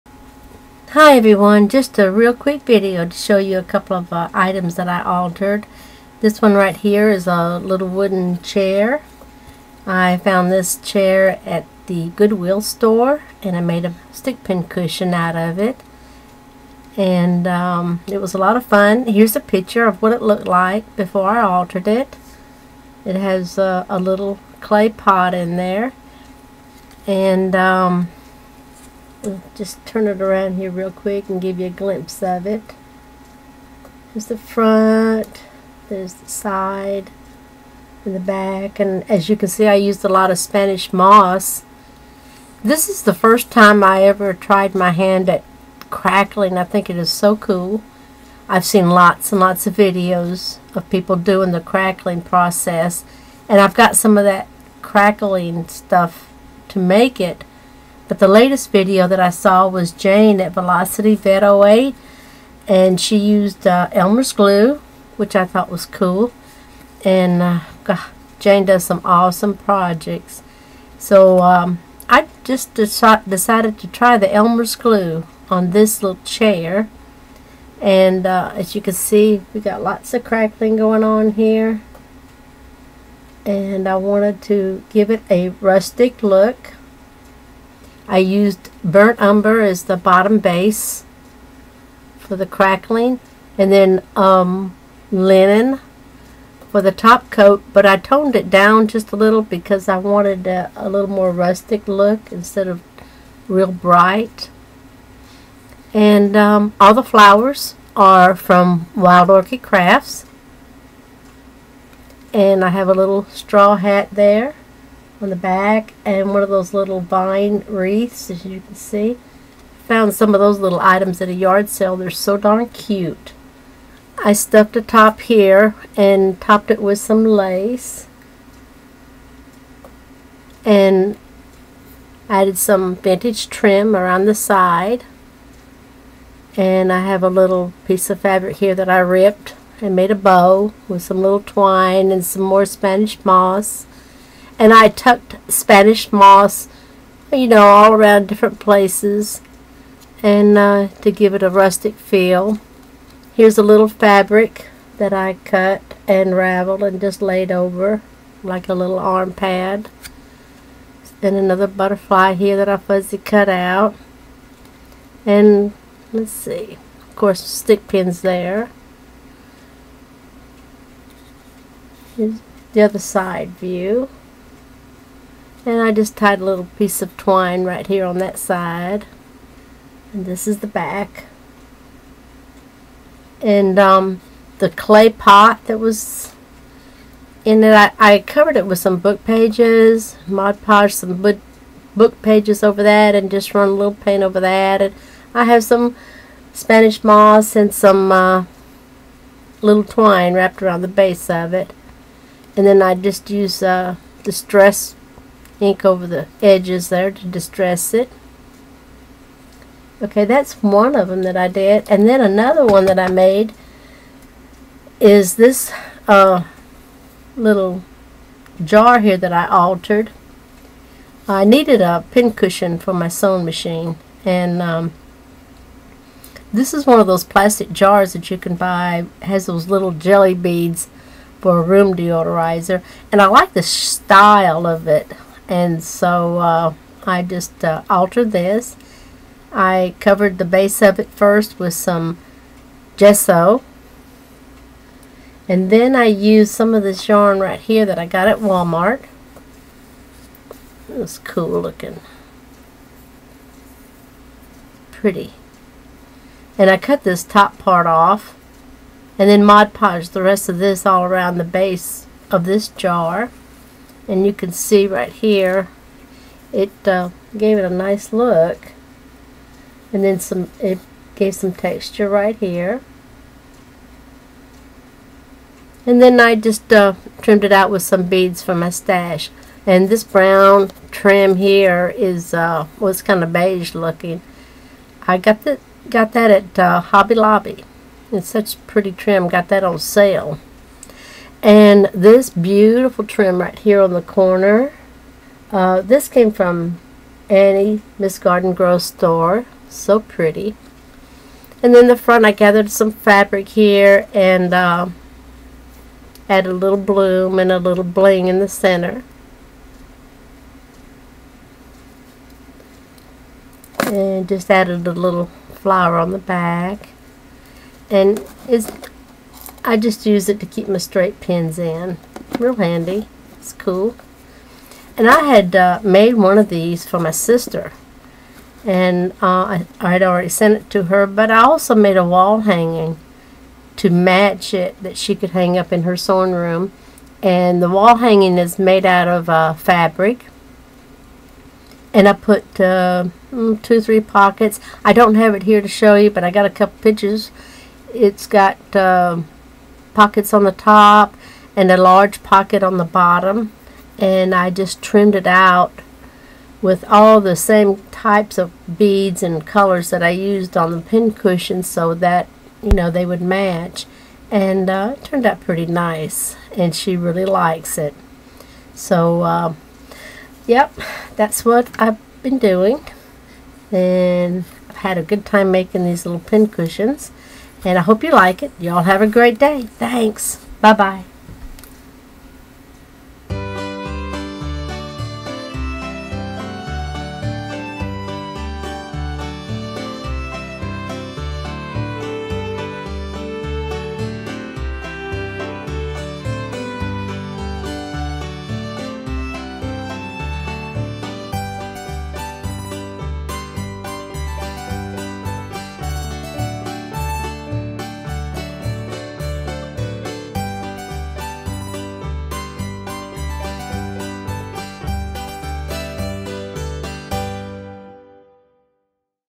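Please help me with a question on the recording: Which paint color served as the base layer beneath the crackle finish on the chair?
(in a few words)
Burnt umber.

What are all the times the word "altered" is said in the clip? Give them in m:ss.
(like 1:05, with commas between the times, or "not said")
0:05, 0:21, 3:39, 3:57.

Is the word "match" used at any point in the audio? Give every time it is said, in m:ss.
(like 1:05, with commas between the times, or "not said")
5:33, 6:03.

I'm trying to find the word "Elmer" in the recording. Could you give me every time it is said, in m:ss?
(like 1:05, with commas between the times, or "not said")
1:03, 1:14.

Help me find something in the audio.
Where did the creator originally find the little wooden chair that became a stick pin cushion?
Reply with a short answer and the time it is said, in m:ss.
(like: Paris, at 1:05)
Goodwill, at 0:12.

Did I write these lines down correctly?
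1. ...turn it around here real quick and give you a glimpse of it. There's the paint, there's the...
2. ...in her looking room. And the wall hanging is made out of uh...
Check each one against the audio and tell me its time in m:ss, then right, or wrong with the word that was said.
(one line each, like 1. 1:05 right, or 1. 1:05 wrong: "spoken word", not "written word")
1. 0:29 wrong: "front", not "paint"
2. 5:35 wrong: "sewing", not "looking".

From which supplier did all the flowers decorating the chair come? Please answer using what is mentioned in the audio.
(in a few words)
Wild Orchid Crafts.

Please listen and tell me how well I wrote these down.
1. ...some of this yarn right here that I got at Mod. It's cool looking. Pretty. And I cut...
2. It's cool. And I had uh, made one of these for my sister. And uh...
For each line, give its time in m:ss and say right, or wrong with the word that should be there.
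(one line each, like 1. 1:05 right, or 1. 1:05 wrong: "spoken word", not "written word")
1. 4:06 wrong: "Walmart", not "Mod"
2. 5:23 right.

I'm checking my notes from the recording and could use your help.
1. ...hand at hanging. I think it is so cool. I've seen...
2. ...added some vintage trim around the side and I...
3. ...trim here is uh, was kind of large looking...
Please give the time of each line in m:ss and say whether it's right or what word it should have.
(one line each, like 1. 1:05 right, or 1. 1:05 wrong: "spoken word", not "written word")
1. 0:44 wrong: "crackling", not "hanging"
2. 2:12 right
3. 4:40 wrong: "beige", not "large".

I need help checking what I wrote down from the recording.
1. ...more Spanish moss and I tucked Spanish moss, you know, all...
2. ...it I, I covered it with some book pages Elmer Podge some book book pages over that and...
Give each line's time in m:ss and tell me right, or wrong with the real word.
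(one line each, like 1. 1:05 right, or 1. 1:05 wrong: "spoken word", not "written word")
1. 2:22 right
2. 3:07 wrong: "Mod", not "Elmer".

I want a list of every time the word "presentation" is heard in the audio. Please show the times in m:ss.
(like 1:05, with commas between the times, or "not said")
not said.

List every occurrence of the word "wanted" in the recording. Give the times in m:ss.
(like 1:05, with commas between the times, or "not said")
1:23, 1:39.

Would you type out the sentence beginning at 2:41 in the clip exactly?
And another butterfly here that I fuzzy cut out.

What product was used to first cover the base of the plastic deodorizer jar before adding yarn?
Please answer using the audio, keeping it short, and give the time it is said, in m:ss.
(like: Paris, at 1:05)
Gesso, at 4:02.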